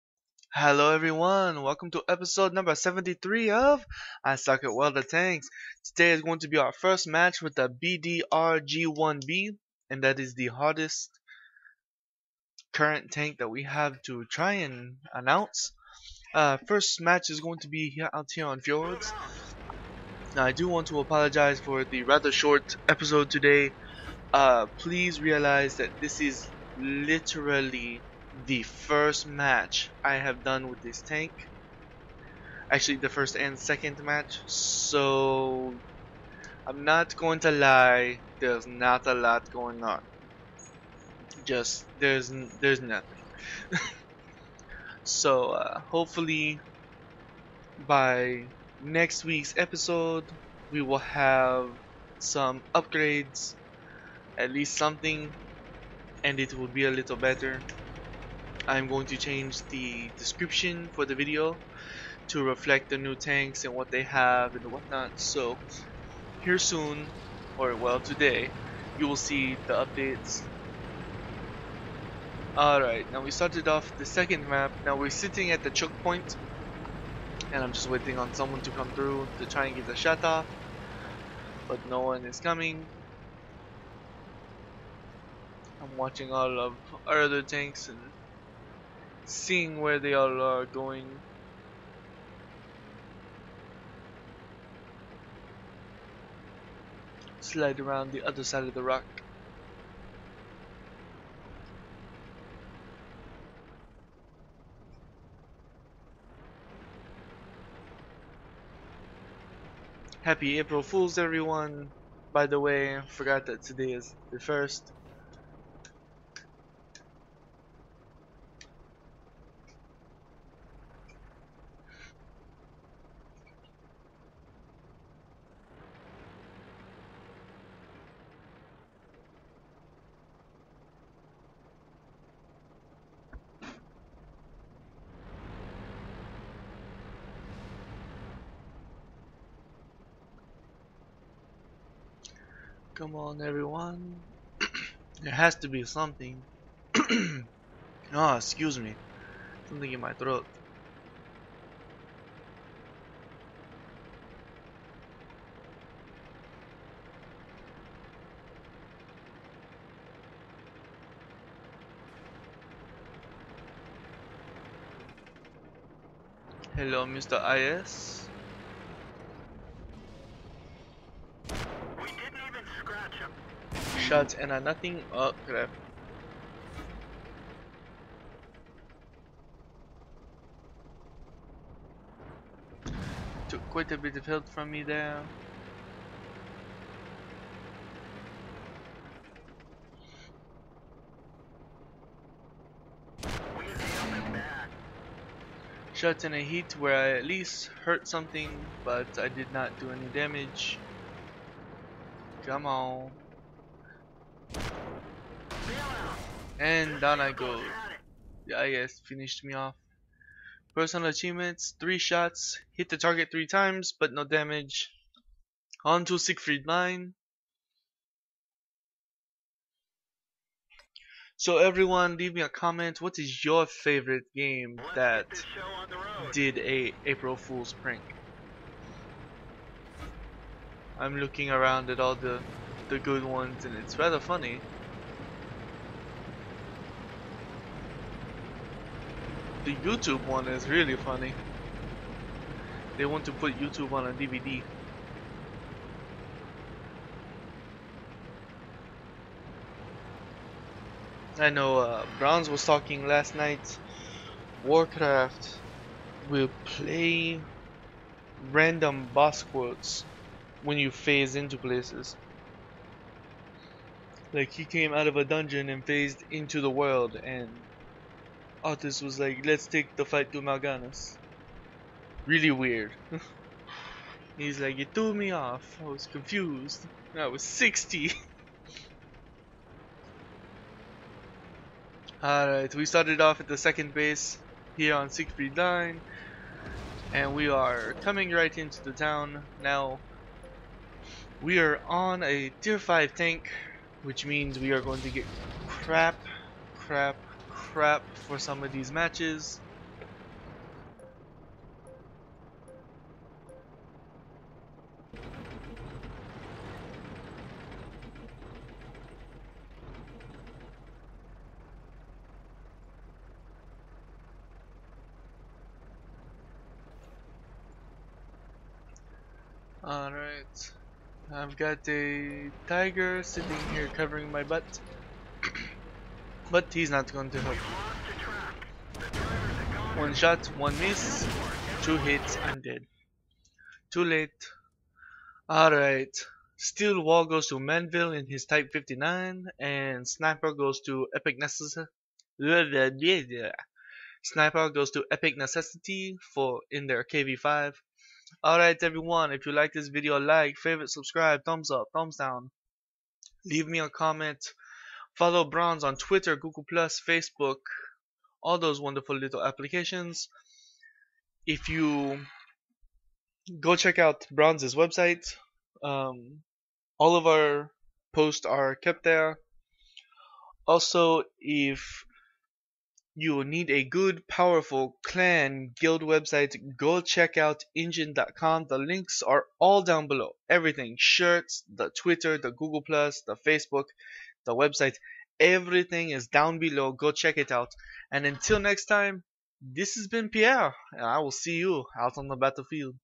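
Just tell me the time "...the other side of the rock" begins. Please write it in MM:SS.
01:38.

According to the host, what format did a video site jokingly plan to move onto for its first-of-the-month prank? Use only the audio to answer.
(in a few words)
DVD.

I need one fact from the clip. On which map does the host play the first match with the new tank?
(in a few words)
Fjords.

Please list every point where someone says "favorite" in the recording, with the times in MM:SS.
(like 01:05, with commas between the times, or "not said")
03:43, 05:50.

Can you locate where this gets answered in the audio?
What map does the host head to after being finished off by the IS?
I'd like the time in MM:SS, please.
03:36.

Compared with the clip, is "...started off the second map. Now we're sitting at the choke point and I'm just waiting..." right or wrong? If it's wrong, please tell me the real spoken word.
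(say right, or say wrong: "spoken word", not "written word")
right.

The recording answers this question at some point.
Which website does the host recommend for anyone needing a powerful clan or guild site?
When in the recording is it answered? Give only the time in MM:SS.
06:17.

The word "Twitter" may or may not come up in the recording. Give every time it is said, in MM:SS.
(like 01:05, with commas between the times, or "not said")
05:55, 06:21.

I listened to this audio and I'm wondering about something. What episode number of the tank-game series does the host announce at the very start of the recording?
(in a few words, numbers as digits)
73.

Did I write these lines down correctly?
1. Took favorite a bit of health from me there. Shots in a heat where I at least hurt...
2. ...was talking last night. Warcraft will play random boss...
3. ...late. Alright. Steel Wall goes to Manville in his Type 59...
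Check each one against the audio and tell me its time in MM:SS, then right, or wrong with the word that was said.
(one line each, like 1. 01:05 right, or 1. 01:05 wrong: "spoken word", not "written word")
1. 03:03 wrong: "quite", not "favorite"
2. 04:12 right
3. 05:34 right.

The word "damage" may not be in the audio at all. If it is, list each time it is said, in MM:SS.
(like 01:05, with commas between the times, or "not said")
03:20, 03:34.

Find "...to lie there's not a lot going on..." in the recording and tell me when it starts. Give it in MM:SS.
00:37.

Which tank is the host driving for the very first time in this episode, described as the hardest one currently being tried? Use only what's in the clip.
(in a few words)
BDR G1B.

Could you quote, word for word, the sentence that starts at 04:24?
Like he came out of a dungeon and phased into the world and Arthas was like, let's take the fight to Mal'Ganis.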